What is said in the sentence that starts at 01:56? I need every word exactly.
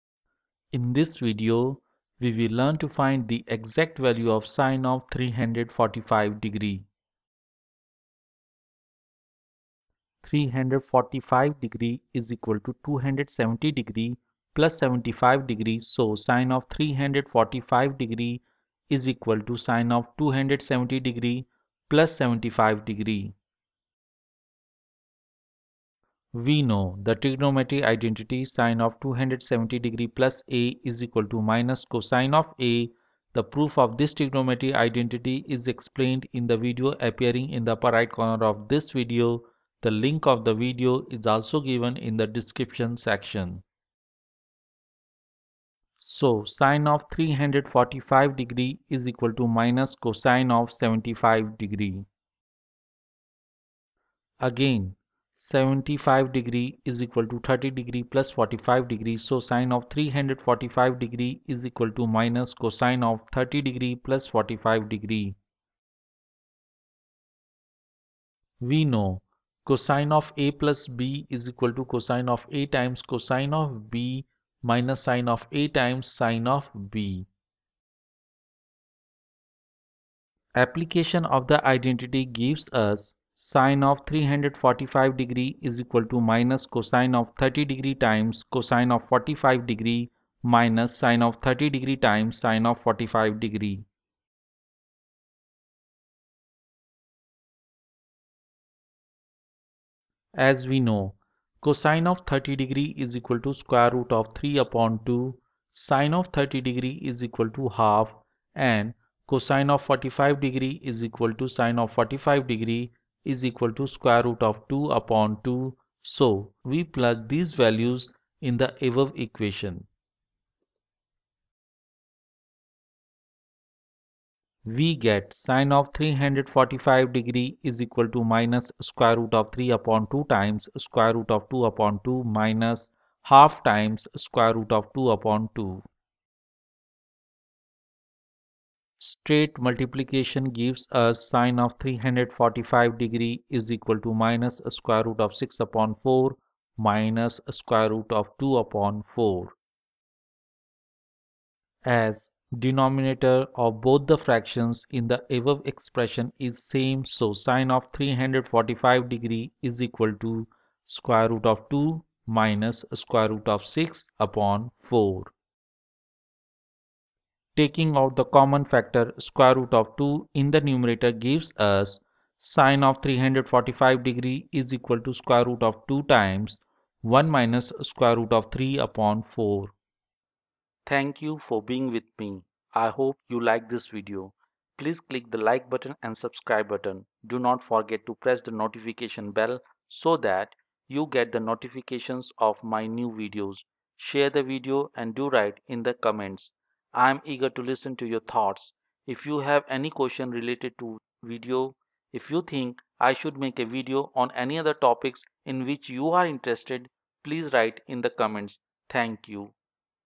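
So, we plug these values in the above equation.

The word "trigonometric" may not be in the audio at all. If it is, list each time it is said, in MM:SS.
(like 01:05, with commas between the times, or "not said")
00:27, 00:34.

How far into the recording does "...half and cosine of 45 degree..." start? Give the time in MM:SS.
01:47.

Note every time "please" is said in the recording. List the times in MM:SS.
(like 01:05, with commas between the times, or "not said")
03:04, 03:27.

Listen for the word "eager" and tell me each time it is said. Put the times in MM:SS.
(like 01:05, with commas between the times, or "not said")
03:17.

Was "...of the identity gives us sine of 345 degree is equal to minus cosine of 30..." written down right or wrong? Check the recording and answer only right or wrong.
right.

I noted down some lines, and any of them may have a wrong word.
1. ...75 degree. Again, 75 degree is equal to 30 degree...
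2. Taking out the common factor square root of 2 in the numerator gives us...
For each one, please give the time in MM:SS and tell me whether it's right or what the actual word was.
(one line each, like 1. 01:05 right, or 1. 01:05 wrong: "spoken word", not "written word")
1. 00:50 right
2. 02:47 right.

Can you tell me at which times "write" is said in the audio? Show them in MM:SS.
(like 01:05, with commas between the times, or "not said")
03:15, 03:27.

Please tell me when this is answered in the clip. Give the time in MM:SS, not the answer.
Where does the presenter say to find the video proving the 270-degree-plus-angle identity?
00:37.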